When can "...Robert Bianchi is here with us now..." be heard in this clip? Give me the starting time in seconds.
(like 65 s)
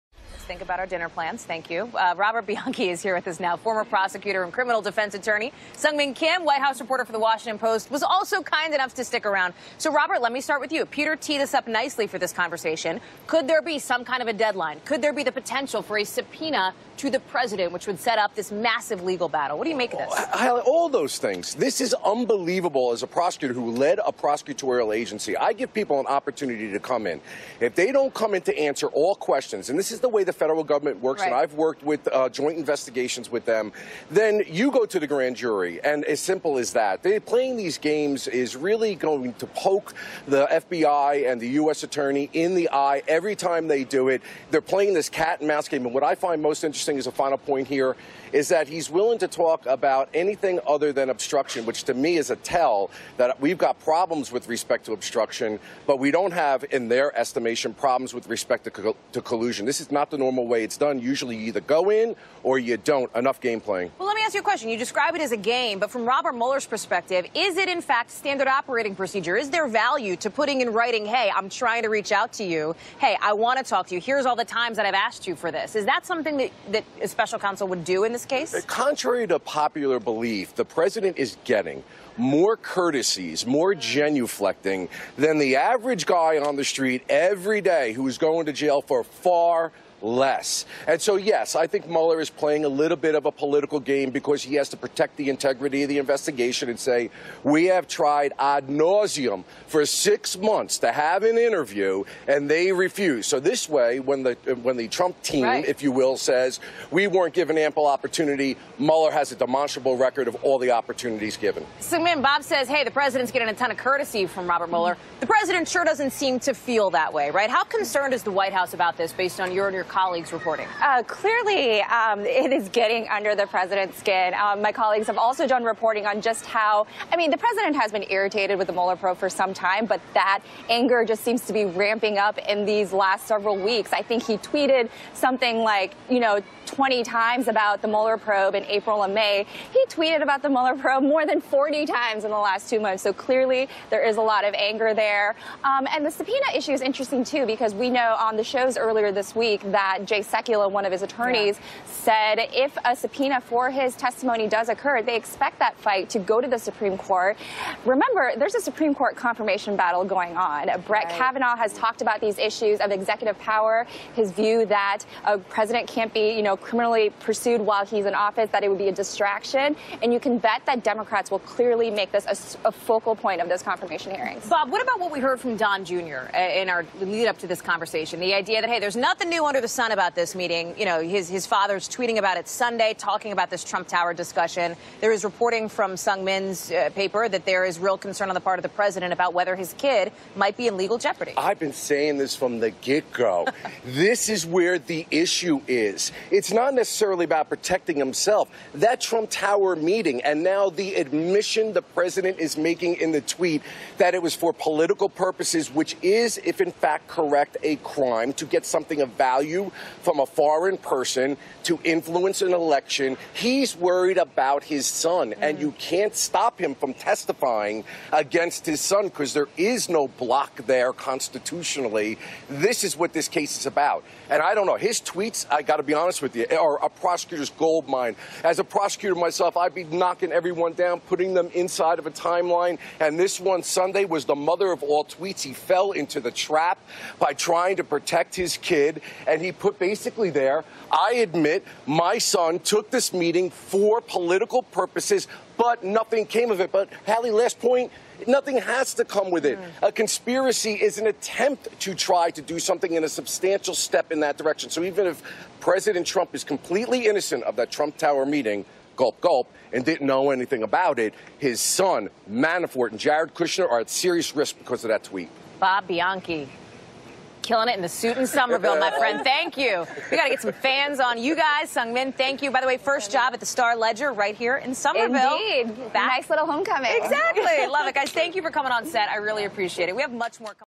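2 s.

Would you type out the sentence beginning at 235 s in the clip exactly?
He fell into the trap by trying to protect his kid.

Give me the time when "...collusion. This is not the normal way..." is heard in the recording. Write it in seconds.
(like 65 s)
59 s.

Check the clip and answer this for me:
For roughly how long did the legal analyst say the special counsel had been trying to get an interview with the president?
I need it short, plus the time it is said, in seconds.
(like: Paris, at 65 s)
6 months, at 99 s.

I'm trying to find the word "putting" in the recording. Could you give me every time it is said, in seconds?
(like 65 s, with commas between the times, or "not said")
70 s, 231 s.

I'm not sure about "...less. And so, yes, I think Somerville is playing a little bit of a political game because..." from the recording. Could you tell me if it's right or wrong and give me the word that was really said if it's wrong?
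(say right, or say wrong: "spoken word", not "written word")
wrong: "Mueller", not "Somerville".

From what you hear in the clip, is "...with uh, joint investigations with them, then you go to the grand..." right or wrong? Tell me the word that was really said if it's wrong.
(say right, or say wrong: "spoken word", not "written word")
right.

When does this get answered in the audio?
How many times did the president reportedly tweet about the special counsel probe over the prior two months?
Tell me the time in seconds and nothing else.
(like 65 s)
141 s.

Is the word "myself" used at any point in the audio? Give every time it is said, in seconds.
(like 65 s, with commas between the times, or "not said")
229 s.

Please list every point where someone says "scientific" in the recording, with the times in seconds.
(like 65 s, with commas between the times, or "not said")
not said.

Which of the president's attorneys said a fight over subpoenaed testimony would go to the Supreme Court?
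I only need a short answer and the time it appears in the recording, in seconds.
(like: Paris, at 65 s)
Jay Sekulow, at 150 s.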